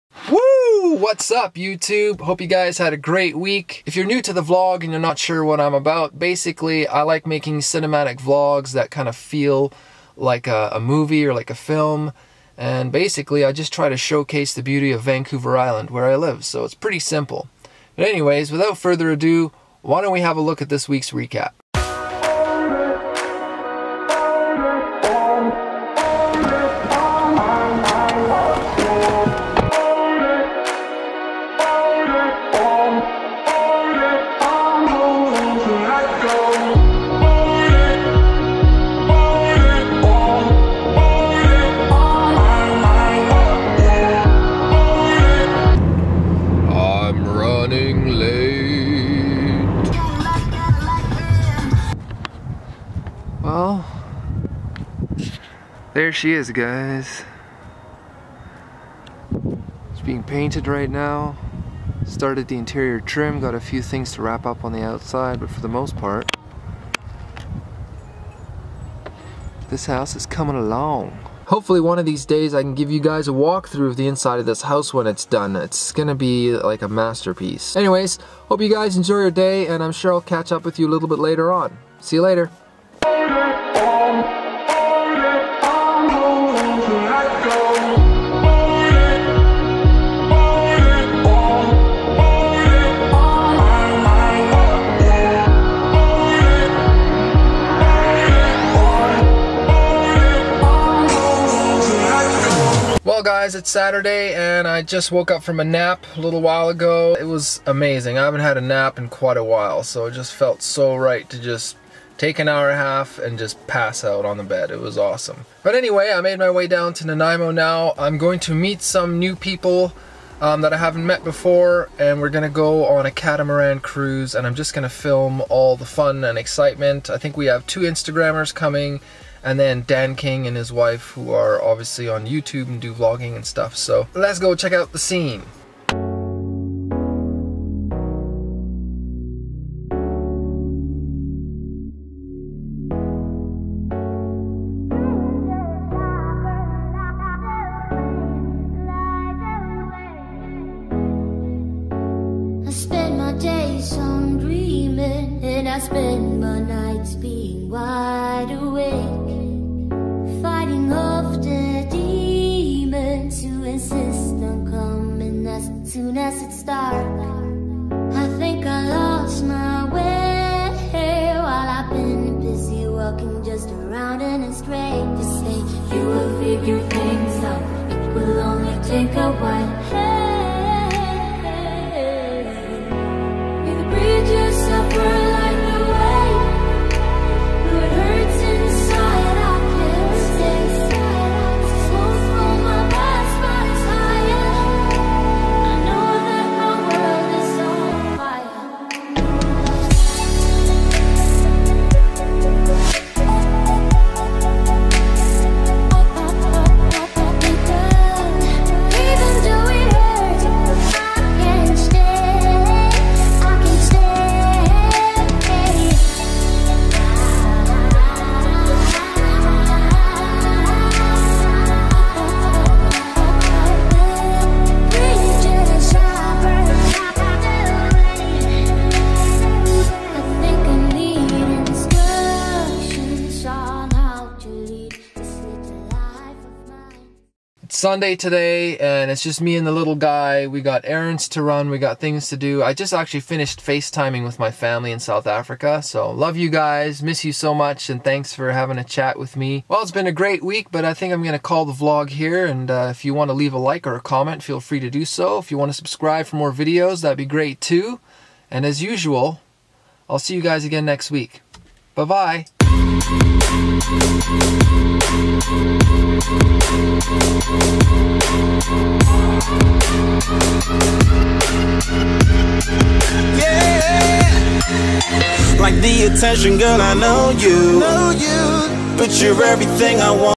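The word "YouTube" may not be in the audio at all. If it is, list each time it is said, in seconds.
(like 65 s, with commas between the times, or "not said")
1 s, 132 s.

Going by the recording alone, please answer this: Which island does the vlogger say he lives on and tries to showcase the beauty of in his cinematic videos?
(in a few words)
Vancouver Island.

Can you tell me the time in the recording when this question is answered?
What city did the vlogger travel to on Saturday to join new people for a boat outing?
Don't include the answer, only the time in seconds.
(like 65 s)
117 s.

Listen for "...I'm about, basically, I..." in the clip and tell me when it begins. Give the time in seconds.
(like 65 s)
5 s.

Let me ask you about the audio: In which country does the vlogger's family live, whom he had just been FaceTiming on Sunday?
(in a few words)
South Africa.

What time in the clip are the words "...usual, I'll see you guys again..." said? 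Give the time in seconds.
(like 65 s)
258 s.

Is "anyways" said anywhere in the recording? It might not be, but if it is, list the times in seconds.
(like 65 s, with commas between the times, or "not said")
18 s, 77 s, 115 s.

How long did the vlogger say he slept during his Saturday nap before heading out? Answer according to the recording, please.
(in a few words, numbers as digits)
an hour and a half.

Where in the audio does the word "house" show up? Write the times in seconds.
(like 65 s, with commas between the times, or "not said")
69 s, 74 s.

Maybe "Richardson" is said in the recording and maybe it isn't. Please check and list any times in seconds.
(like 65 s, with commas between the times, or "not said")
not said.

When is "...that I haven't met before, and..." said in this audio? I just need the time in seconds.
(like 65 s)
120 s.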